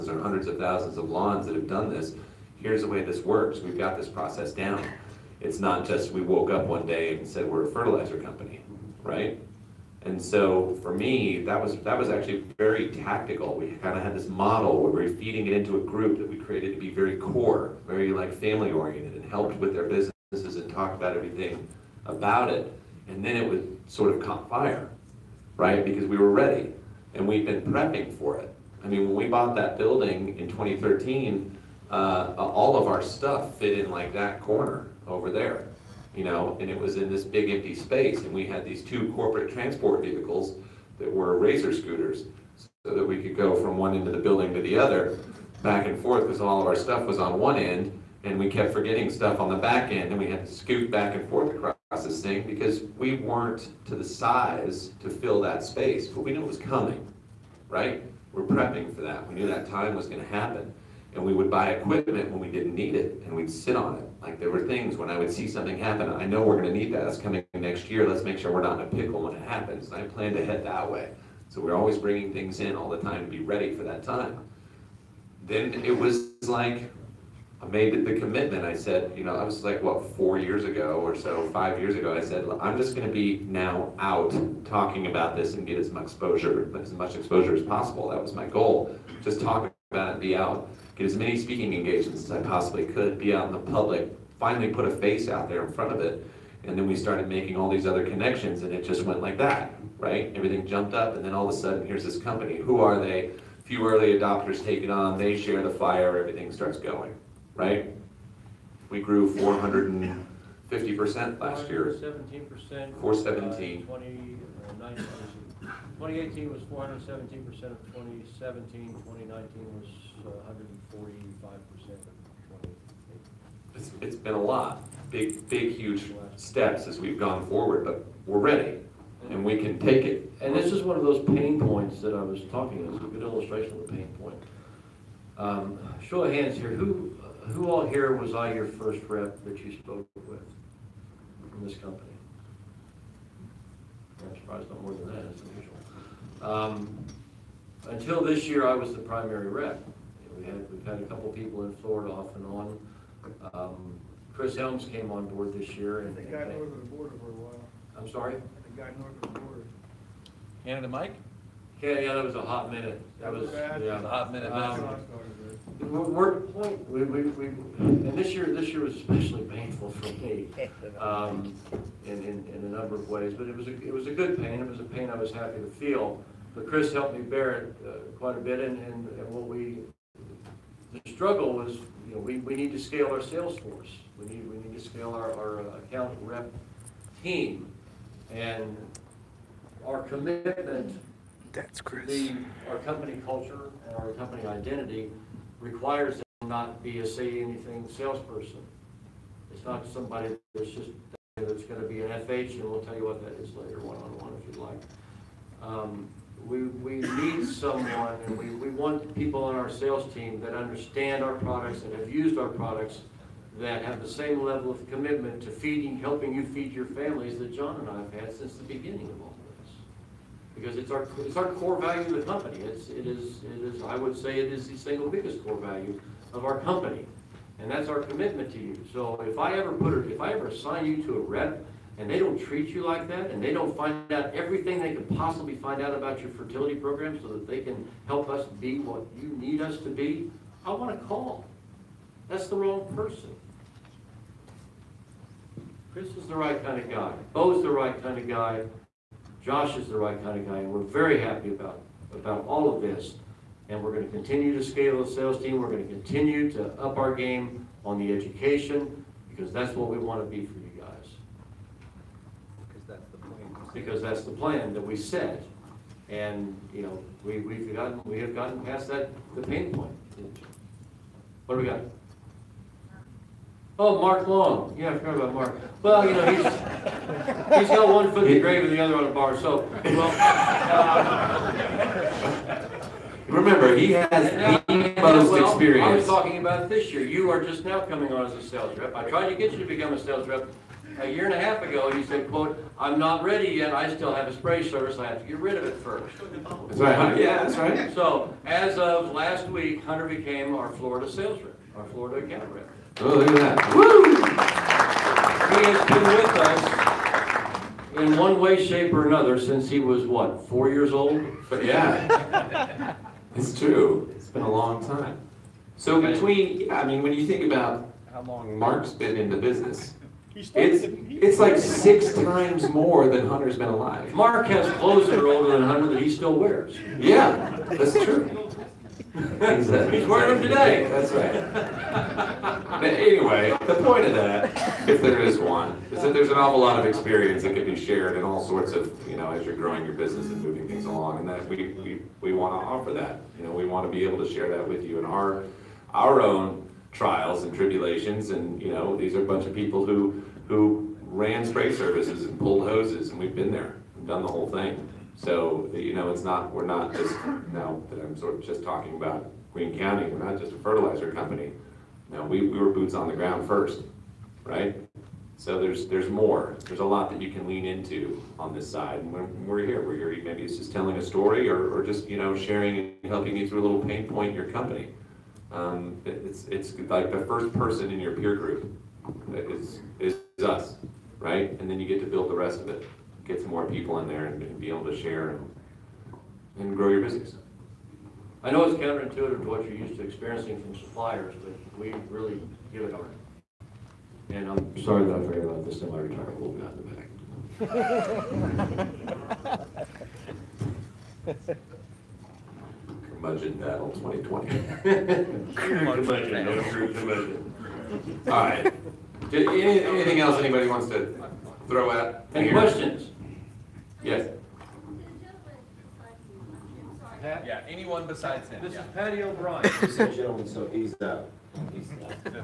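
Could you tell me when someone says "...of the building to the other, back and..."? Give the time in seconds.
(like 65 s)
44 s.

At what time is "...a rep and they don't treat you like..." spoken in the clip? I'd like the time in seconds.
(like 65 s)
231 s.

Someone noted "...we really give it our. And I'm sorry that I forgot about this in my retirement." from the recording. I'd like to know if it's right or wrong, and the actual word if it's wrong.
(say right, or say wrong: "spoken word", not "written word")
right.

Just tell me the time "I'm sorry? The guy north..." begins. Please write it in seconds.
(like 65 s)
157 s.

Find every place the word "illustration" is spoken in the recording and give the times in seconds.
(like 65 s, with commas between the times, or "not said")
133 s.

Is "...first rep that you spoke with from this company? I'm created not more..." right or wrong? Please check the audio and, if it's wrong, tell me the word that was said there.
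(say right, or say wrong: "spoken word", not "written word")
wrong: "surprised", not "created".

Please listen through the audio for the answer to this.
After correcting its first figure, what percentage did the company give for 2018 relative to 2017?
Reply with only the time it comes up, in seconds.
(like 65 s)
116 s.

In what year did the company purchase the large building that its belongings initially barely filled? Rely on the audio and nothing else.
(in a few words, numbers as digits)
2013.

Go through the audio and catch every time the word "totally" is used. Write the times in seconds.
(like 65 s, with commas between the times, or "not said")
not said.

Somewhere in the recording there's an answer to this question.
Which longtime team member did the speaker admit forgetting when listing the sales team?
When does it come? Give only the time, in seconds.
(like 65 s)
273 s.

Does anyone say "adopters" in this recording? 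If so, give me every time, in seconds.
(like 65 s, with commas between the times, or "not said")
104 s.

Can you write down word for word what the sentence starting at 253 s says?
And we're going to continue to scale the sales team.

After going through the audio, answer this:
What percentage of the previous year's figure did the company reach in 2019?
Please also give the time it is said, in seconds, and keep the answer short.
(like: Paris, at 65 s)
145%, at 120 s.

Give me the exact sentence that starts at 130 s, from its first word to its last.
And this is one of those pain points that I was talking.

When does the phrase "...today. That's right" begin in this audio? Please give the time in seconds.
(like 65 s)
330 s.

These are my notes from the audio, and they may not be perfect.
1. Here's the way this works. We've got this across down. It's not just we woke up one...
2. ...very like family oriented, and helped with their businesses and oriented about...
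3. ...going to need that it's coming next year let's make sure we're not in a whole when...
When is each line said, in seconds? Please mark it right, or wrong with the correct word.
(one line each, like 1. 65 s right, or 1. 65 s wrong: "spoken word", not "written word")
1. 2 s wrong: "process", not "across"
2. 17 s wrong: "talked", not "oriented"
3. 66 s wrong: "pickle", not "whole".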